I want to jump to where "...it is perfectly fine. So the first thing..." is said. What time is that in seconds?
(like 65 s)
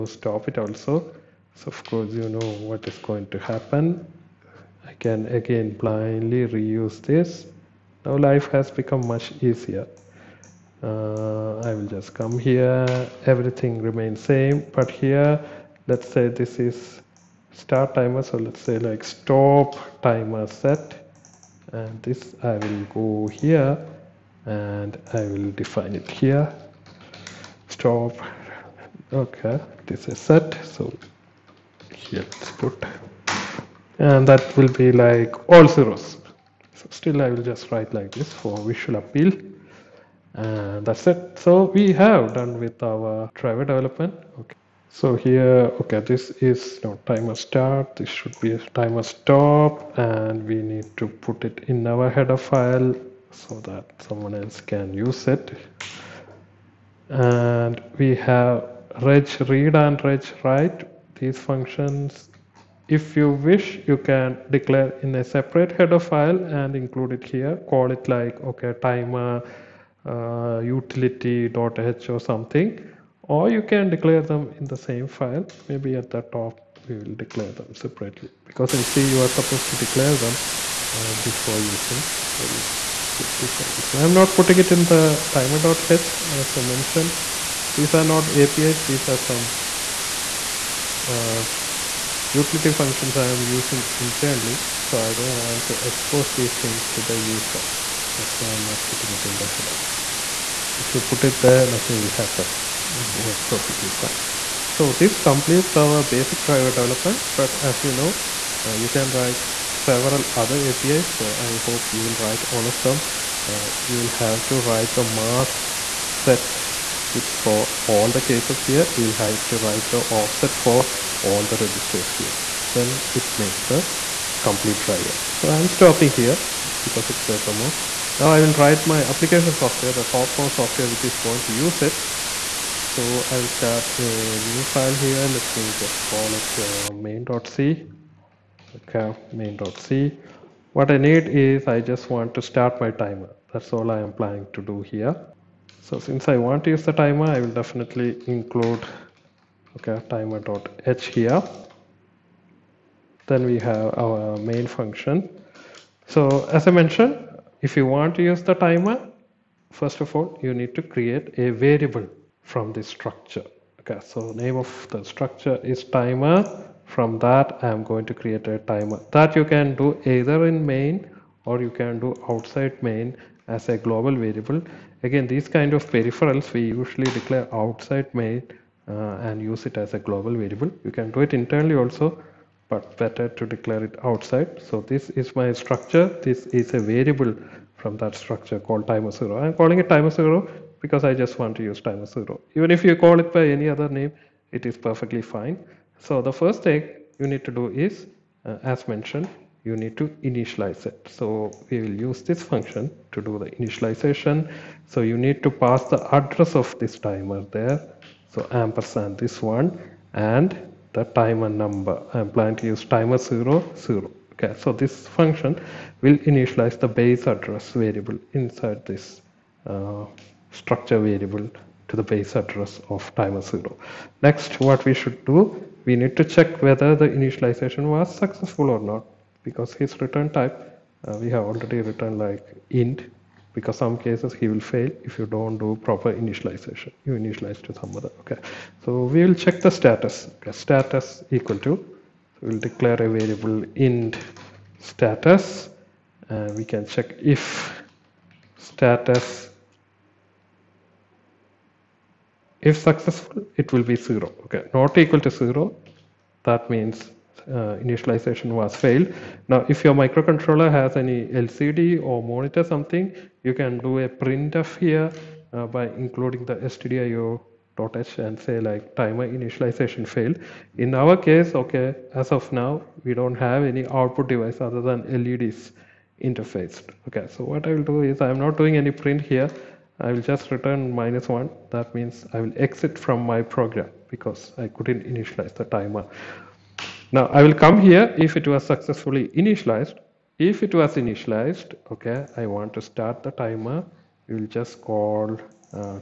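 194 s.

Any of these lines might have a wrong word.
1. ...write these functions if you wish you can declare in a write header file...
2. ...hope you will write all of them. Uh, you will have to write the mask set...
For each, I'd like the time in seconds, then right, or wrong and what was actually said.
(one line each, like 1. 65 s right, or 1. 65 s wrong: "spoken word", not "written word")
1. 60 s wrong: "separate", not "write"
2. 111 s right.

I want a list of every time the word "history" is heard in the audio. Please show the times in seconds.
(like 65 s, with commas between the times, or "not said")
not said.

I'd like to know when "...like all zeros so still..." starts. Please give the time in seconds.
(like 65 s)
35 s.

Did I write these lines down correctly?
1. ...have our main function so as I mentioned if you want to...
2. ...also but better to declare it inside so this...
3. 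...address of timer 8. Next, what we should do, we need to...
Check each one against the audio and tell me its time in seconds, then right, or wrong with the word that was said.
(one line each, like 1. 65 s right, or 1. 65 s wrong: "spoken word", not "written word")
1. 153 s right
2. 181 s wrong: "outside", not "inside"
3. 222 s wrong: "0", not "8".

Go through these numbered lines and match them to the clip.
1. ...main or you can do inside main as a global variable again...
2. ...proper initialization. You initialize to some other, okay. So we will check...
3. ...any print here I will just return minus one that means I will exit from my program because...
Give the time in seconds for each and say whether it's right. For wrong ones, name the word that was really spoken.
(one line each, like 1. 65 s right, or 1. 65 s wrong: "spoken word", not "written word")
1. 170 s wrong: "outside", not "inside"
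2. 235 s right
3. 278 s right.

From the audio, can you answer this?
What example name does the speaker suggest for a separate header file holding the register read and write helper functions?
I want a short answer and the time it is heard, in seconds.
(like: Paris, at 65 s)
utility.h, at 70 s.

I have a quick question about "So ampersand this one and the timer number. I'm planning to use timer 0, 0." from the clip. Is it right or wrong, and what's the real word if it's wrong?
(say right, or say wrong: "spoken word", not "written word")
right.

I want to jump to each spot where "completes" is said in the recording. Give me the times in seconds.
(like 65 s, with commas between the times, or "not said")
105 s, 124 s.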